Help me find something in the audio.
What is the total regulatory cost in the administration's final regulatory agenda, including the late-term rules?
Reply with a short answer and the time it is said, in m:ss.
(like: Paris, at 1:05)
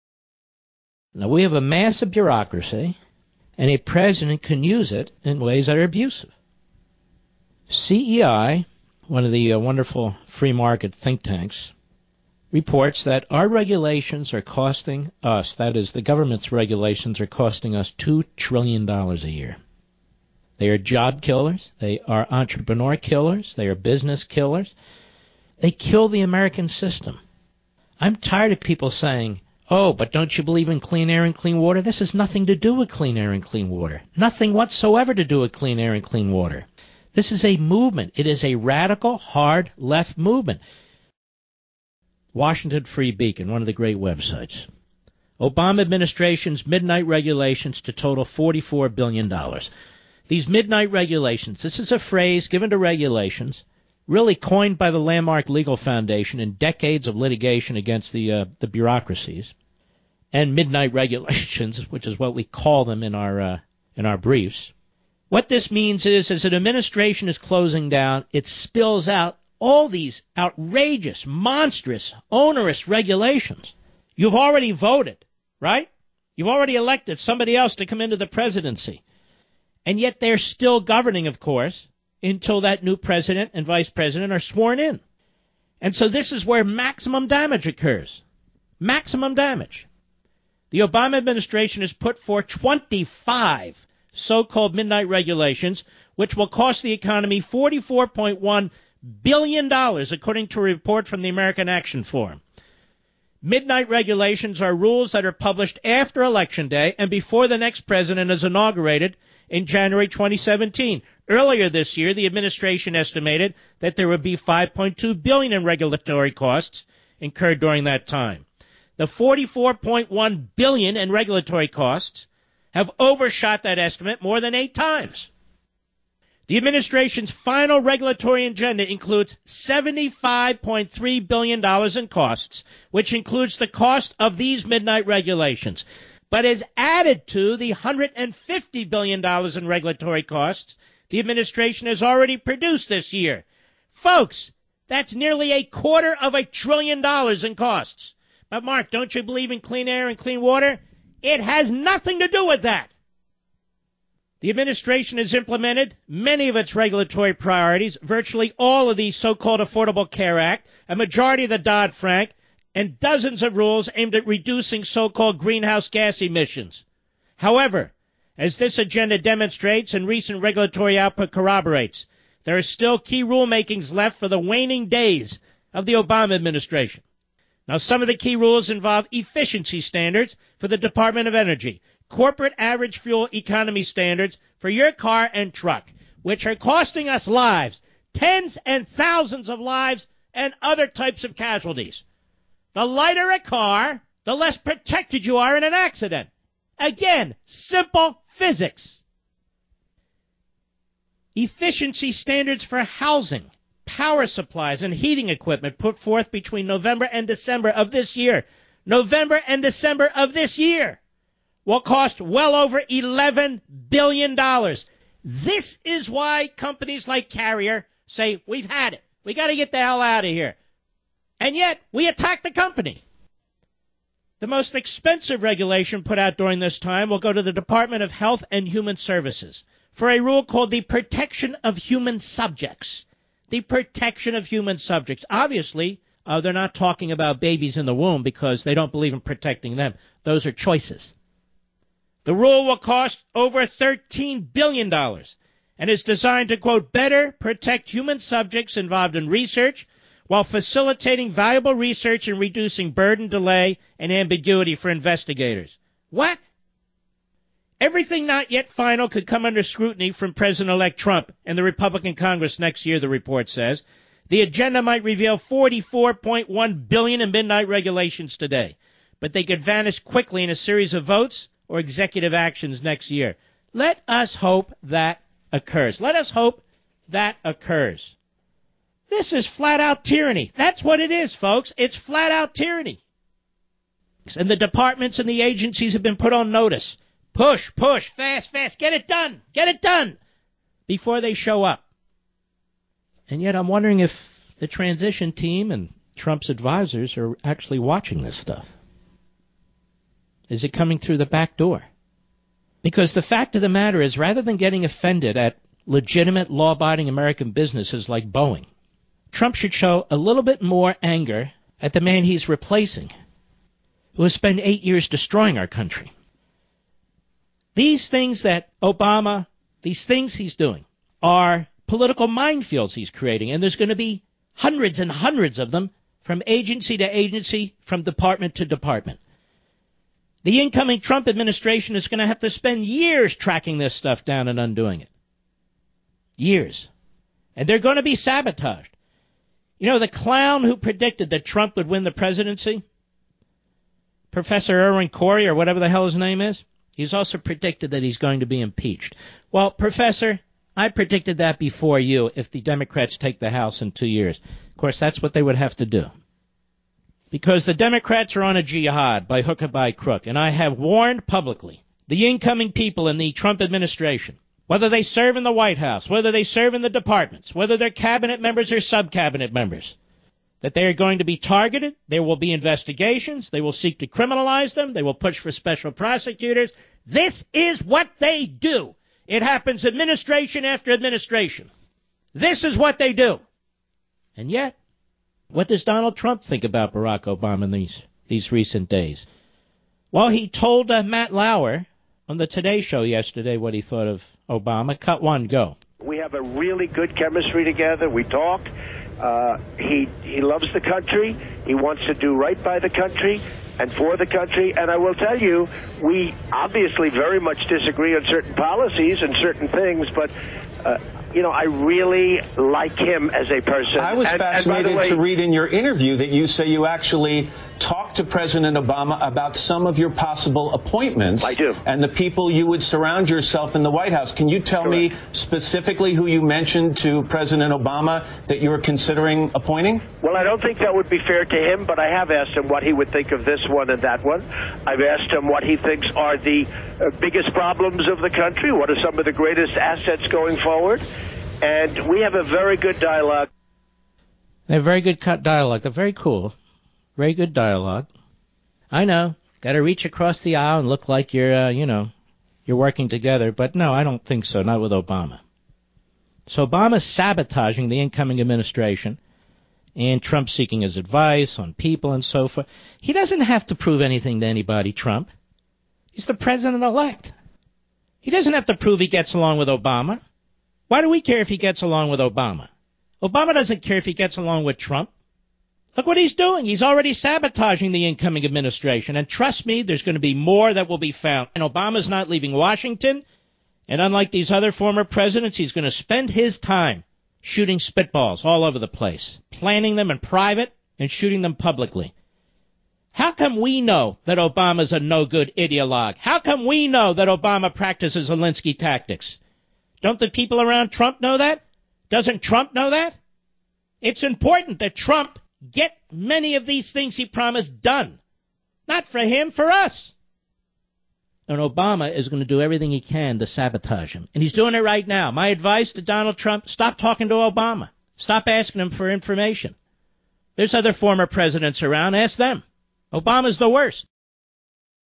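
$75.3 billion, at 2:09.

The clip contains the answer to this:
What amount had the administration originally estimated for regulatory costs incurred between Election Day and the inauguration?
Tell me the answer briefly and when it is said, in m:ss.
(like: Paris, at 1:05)
5.2 billion, at 1:54.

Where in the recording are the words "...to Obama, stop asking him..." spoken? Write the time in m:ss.
8:37.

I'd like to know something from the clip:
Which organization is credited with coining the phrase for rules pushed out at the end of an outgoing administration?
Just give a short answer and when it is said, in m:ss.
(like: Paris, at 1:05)
Landmark Legal Foundation, at 0:54.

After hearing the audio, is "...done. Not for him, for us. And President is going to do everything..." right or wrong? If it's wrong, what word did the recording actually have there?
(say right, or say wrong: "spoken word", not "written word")
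wrong: "Obama", not "President".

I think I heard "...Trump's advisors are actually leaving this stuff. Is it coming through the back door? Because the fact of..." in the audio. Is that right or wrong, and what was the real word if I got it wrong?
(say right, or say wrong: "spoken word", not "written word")
wrong: "watching", not "leaving".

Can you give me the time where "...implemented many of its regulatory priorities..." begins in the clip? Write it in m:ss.
2:35.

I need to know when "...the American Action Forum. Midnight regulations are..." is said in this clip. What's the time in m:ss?
1:41.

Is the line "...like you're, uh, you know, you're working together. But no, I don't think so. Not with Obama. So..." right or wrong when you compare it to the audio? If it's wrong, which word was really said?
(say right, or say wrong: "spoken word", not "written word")
right.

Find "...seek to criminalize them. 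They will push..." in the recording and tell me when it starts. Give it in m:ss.
6:13.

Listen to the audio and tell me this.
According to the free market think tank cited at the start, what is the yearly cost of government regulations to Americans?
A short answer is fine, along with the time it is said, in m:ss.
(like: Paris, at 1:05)
$2 trillion, at 0:17.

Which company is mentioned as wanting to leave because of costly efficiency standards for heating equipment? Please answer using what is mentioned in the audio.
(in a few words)
Carrier.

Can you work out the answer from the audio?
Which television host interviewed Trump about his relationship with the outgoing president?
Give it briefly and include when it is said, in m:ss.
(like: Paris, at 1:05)
Matt Lauer, at 6:31.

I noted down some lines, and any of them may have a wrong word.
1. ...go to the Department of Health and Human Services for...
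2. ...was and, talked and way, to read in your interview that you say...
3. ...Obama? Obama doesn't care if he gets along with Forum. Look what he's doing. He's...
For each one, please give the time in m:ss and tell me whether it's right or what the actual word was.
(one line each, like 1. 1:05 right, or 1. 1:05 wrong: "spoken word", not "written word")
1. 3:47 right
2. 6:54 wrong: "fascinated", not "talked"
3. 7:52 wrong: "Trump", not "Forum".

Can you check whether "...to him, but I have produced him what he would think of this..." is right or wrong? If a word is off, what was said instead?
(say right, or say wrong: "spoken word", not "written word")
wrong: "asked", not "produced".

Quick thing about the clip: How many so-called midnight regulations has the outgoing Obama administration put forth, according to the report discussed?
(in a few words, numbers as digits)
25.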